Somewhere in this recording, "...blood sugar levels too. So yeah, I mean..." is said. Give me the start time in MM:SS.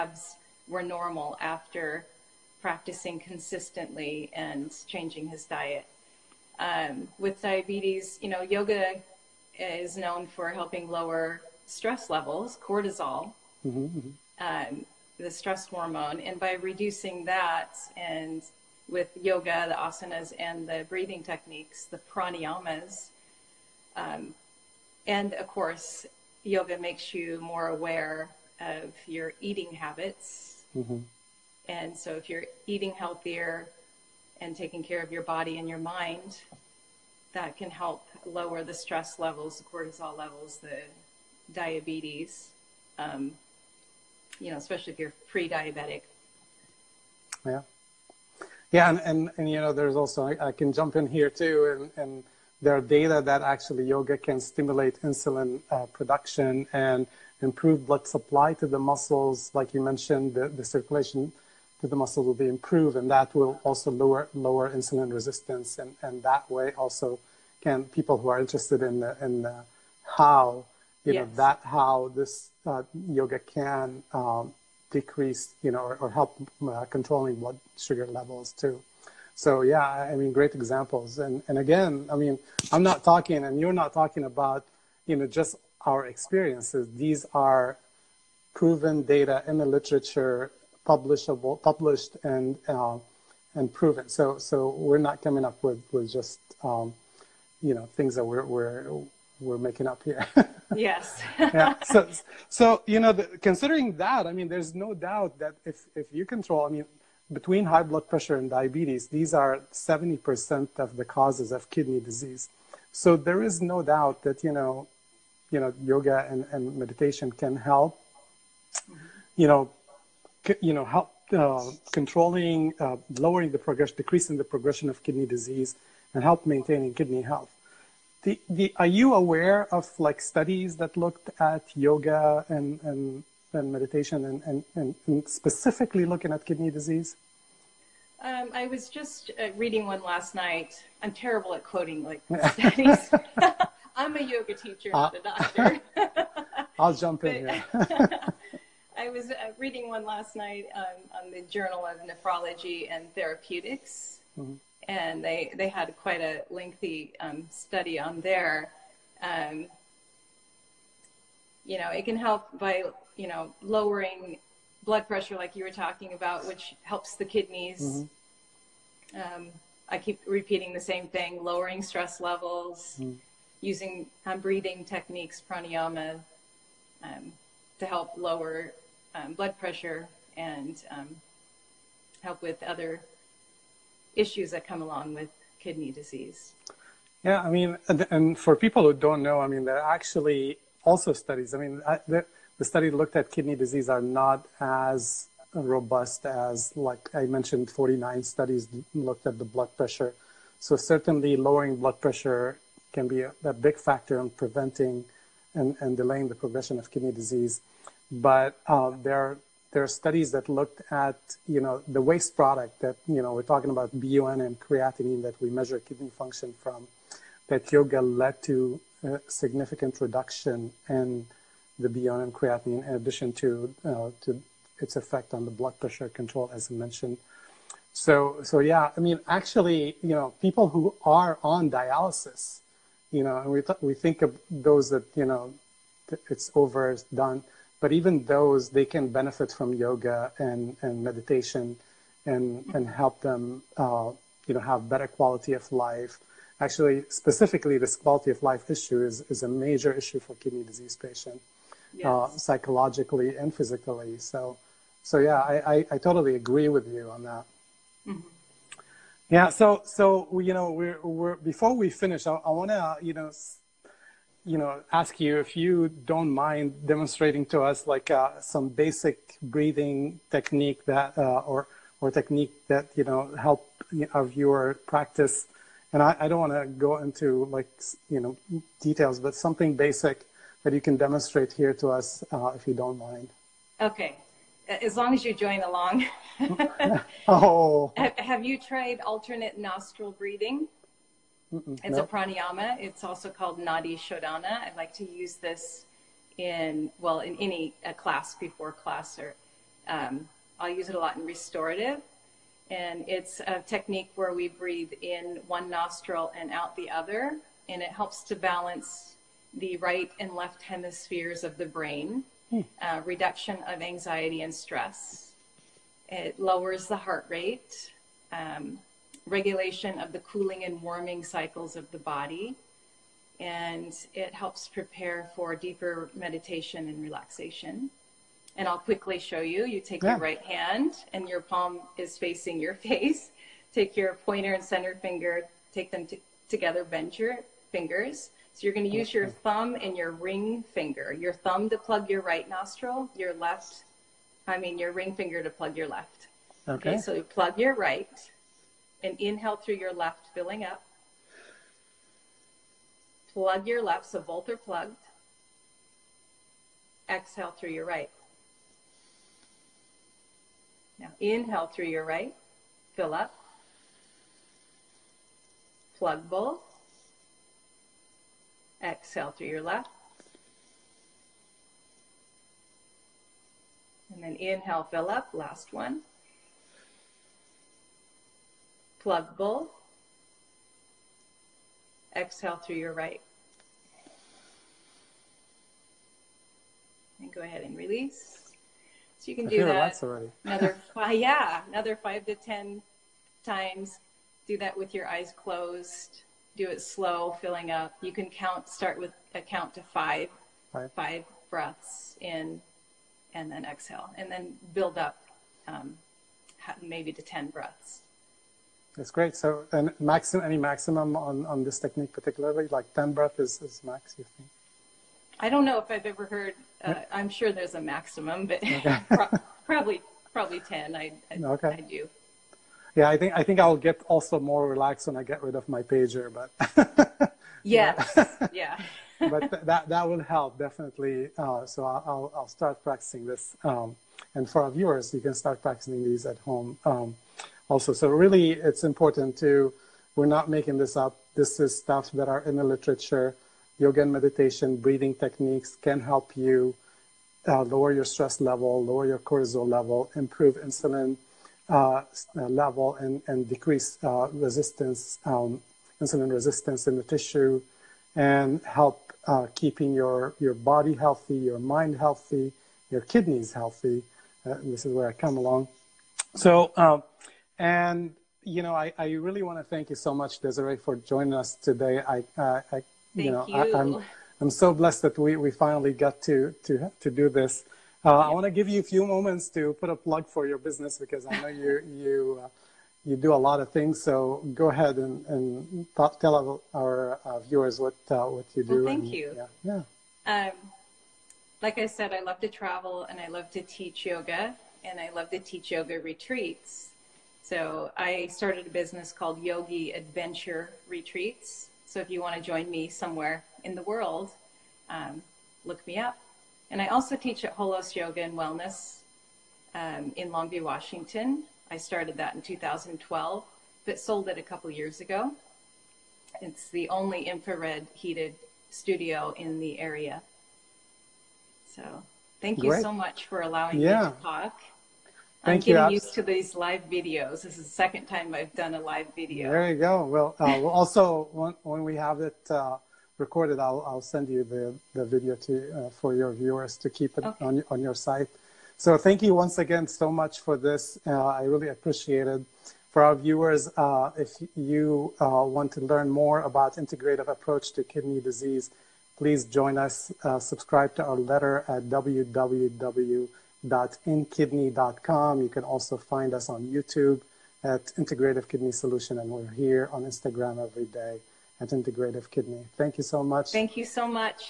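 01:17.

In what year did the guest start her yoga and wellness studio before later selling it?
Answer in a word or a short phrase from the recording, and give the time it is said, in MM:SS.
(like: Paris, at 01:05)
2012, at 08:32.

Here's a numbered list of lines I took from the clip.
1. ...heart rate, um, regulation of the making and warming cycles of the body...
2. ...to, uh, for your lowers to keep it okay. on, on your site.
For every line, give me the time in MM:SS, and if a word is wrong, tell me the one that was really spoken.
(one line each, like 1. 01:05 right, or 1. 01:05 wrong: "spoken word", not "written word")
1. 05:16 wrong: "cooling", not "making"
2. 08:55 wrong: "viewers", not "lowers".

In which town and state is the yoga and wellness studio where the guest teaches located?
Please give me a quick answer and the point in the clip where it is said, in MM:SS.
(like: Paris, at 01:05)
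Longview, Washington, at 08:30.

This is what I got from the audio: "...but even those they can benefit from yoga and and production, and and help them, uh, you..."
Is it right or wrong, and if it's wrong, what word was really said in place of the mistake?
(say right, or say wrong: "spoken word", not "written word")
wrong: "meditation", not "production".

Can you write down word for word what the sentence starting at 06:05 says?
Plug both Exhale through your left.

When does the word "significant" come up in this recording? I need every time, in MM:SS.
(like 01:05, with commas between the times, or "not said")
03:39.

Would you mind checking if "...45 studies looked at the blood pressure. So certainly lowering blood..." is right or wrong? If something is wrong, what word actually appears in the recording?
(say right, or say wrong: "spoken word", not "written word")
wrong: "49", not "45".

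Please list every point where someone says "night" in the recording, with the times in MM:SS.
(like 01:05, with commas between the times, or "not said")
02:20, 02:30.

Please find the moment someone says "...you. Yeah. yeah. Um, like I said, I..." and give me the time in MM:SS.
08:09.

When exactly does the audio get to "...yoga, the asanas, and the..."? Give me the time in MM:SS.
00:19.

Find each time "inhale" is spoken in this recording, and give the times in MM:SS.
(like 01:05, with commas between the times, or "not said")
05:49, 06:01, 06:14.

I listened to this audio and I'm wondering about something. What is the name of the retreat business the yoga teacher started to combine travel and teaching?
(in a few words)
Yogi Adventure Retreats.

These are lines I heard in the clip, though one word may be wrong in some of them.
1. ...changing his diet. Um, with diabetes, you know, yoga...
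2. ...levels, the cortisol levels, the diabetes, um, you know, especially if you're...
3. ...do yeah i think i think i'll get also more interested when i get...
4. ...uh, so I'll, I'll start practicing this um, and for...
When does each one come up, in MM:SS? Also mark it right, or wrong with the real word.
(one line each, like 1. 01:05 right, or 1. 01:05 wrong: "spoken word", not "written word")
1. 00:04 right
2. 00:39 right
3. 07:01 wrong: "relaxed", not "interested"
4. 07:11 right.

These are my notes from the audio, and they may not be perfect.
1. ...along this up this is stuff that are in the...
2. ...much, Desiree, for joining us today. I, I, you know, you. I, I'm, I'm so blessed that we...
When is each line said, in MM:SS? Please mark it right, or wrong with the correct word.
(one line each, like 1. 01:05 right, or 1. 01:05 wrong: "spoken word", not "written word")
1. 07:20 wrong: "making", not "along"
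2. 07:50 right.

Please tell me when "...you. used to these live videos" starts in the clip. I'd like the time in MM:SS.
08:45.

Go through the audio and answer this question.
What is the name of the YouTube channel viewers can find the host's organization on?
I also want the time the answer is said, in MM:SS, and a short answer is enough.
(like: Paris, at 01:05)
Integrative Kidney Solution, at 09:17.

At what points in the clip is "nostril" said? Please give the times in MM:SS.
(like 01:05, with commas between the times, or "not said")
04:49, 05:05, 05:42.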